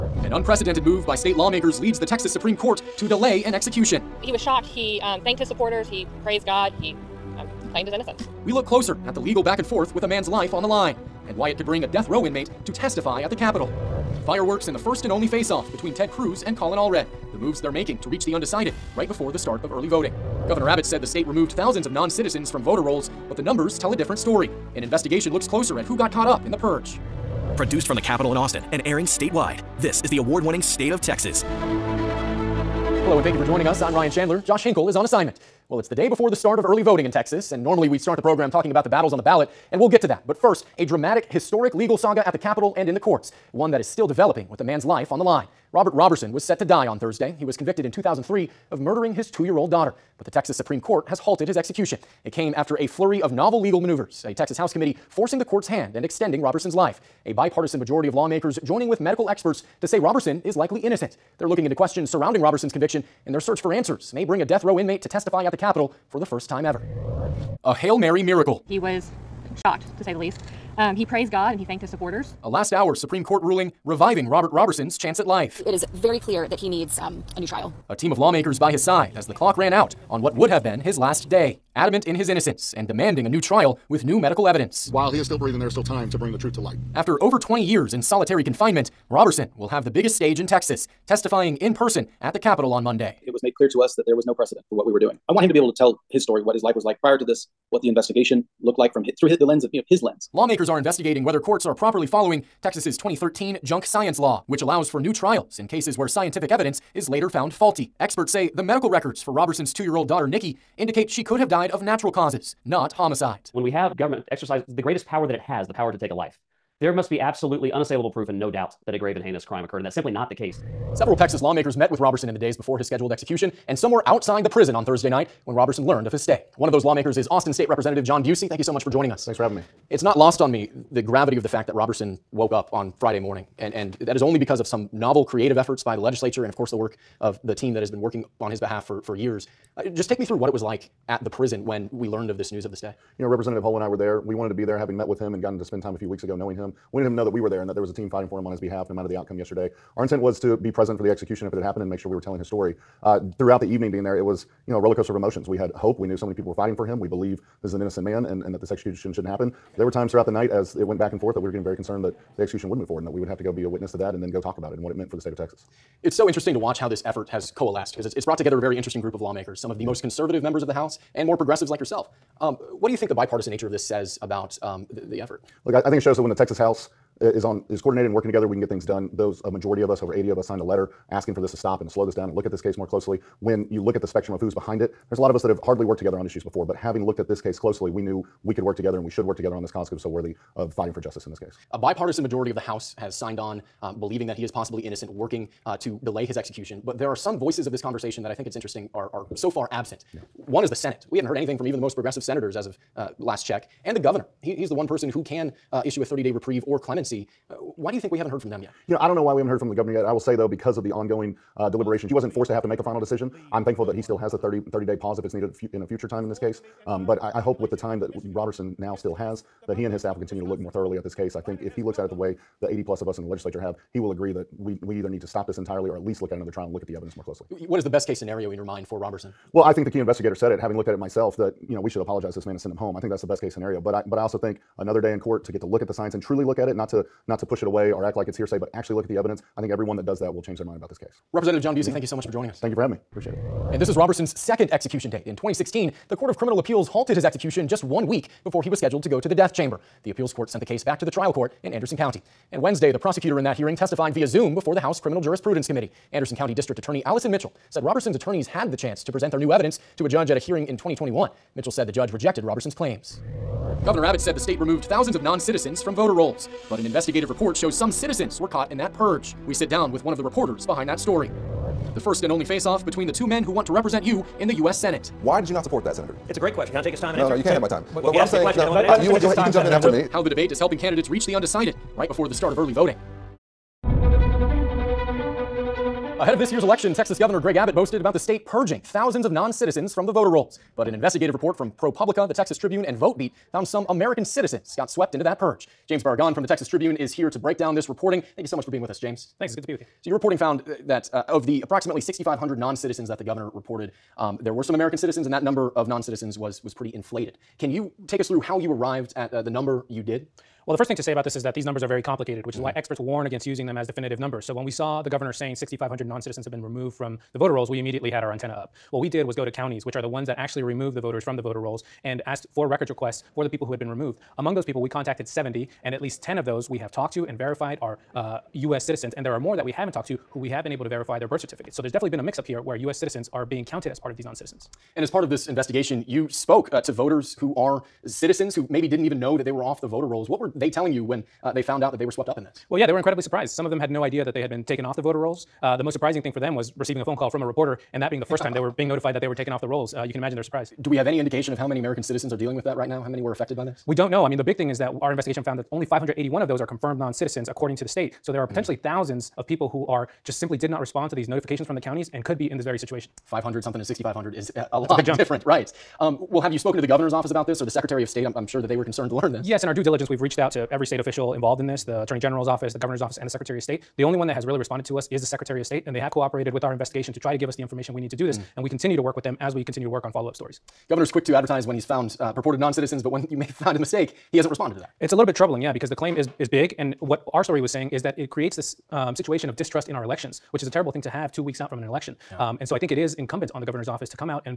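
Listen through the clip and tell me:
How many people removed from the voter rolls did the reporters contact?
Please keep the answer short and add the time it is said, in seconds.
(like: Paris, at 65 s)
70, at 325 s.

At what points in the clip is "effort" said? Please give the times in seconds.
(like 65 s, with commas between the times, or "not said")
135 s, 167 s, 175 s.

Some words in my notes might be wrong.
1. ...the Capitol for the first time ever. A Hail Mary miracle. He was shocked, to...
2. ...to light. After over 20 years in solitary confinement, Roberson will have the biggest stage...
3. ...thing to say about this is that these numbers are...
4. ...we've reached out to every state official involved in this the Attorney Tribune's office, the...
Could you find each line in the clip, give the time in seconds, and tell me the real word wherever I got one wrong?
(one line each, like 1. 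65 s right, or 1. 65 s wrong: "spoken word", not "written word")
1. 65 s right
2. 86 s right
3. 310 s right
4. 370 s wrong: "General", not "Tribune".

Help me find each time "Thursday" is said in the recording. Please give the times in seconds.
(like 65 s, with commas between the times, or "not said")
46 s, 124 s.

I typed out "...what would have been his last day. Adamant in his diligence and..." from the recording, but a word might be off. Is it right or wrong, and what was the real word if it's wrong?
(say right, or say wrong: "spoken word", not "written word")
wrong: "innocence", not "diligence".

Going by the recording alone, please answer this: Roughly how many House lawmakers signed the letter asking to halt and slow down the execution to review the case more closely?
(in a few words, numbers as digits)
over 80.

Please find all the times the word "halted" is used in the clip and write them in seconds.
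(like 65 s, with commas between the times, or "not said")
51 s, 246 s.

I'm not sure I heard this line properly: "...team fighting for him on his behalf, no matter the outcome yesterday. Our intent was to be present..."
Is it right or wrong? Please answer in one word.
right.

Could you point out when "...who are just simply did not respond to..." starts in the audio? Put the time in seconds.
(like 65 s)
359 s.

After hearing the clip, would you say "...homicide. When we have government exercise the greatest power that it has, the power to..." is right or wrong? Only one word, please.
right.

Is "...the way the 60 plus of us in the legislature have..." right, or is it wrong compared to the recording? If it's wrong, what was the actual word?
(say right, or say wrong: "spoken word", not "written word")
wrong: "80", not "60".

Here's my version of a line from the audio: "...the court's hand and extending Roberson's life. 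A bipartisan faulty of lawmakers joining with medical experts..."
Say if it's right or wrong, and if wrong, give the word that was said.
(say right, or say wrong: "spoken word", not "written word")
wrong: "majority", not "faulty".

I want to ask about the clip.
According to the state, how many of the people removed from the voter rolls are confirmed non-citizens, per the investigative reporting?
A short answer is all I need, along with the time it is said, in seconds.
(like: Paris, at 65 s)
581, at 355 s.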